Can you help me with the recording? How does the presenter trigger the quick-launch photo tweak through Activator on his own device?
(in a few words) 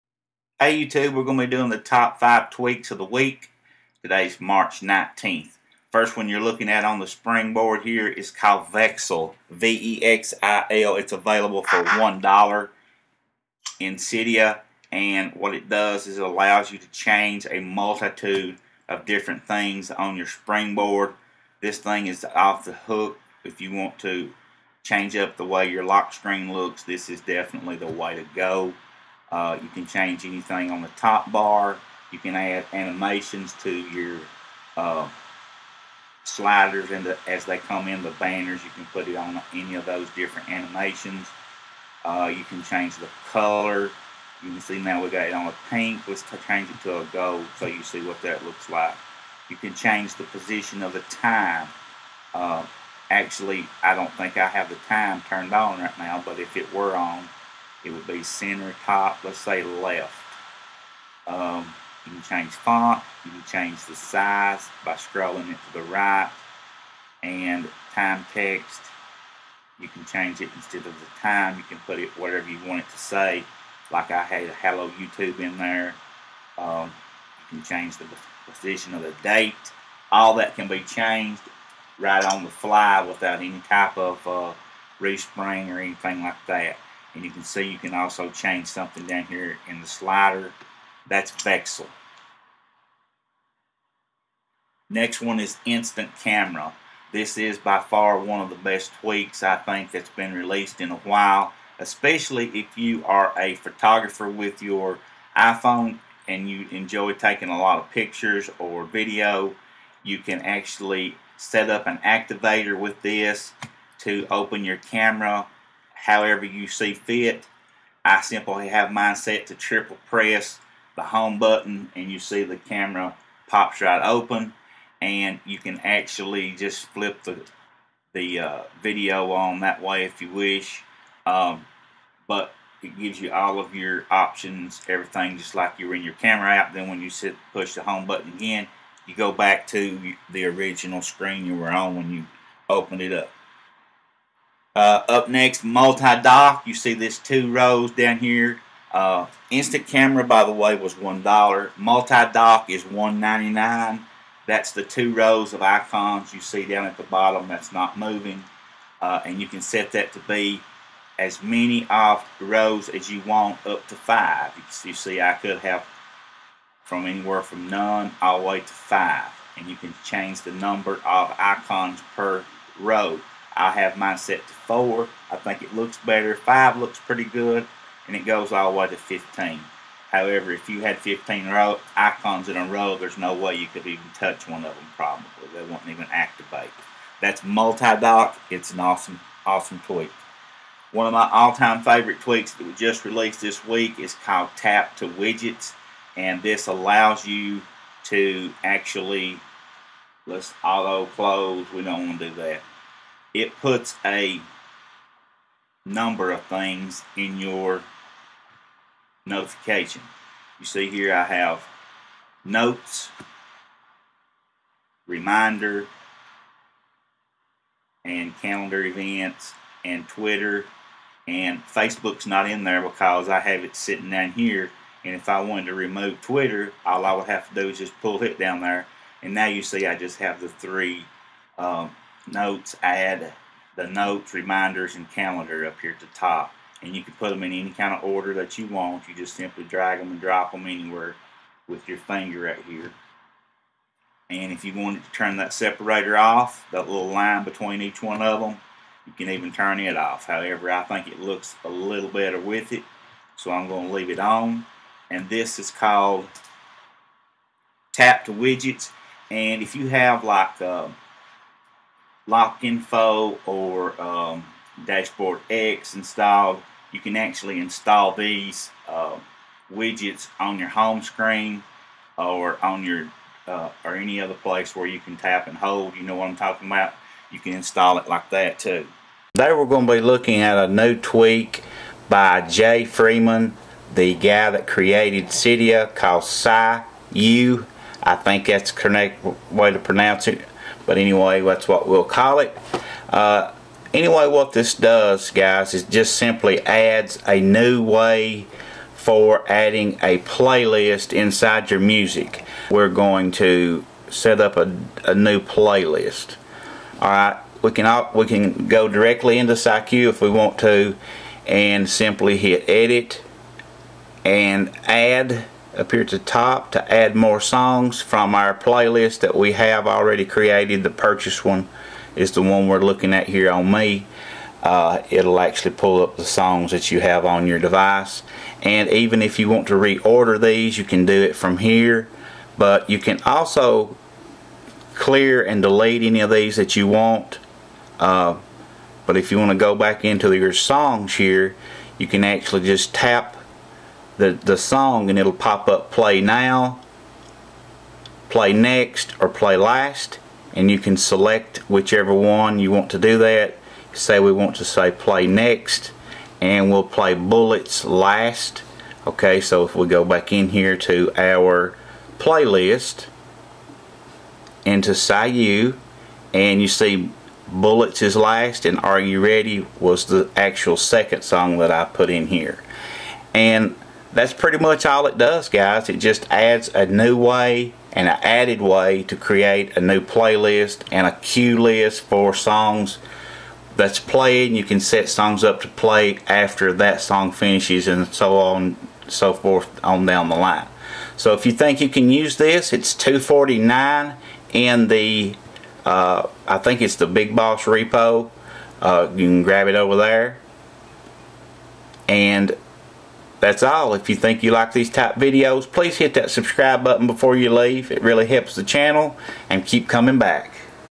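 Triple press the home button.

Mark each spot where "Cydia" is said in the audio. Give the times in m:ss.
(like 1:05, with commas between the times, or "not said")
0:13, 4:45.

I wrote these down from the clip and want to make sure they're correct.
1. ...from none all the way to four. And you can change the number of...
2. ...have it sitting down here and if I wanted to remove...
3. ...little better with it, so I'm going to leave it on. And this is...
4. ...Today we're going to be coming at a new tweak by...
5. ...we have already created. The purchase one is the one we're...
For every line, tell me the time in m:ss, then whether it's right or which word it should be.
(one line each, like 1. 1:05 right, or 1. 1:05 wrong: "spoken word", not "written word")
1. 2:47 wrong: "five", not "four"
2. 3:43 right
3. 4:11 right
4. 4:39 wrong: "looking", not "coming"
5. 5:19 right.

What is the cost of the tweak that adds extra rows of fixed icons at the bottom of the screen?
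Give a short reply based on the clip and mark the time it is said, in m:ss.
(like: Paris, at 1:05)
$1.99, at 2:32.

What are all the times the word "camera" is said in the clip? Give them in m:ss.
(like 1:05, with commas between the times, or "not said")
1:36, 1:54, 2:02, 2:16, 2:29.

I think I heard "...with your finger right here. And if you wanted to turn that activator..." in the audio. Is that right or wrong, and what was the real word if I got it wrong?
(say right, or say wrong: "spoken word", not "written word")
wrong: "separator", not "activator".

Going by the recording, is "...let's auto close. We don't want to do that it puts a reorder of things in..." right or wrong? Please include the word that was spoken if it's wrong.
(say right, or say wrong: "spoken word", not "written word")
wrong: "number", not "reorder".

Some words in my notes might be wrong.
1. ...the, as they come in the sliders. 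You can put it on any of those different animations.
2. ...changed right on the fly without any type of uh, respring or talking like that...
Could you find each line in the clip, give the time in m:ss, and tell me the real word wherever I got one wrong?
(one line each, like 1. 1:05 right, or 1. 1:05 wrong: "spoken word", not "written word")
1. 0:37 wrong: "banners", not "sliders"
2. 1:20 wrong: "anything", not "talking".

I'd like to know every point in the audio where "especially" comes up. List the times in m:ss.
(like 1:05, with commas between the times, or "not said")
1:41.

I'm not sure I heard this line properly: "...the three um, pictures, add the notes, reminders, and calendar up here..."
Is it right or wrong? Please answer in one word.
wrong.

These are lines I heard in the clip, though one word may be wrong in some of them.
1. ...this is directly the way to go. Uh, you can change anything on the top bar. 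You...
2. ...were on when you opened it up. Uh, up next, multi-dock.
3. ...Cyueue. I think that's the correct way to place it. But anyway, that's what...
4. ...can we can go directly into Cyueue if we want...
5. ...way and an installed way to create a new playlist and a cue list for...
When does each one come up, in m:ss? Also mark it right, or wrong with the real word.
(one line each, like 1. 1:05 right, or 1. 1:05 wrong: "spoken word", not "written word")
1. 0:26 wrong: "definitely", not "directly"
2. 2:21 right
3. 4:46 wrong: "pronounce", not "place"
4. 5:07 right
5. 6:17 wrong: "added", not "installed".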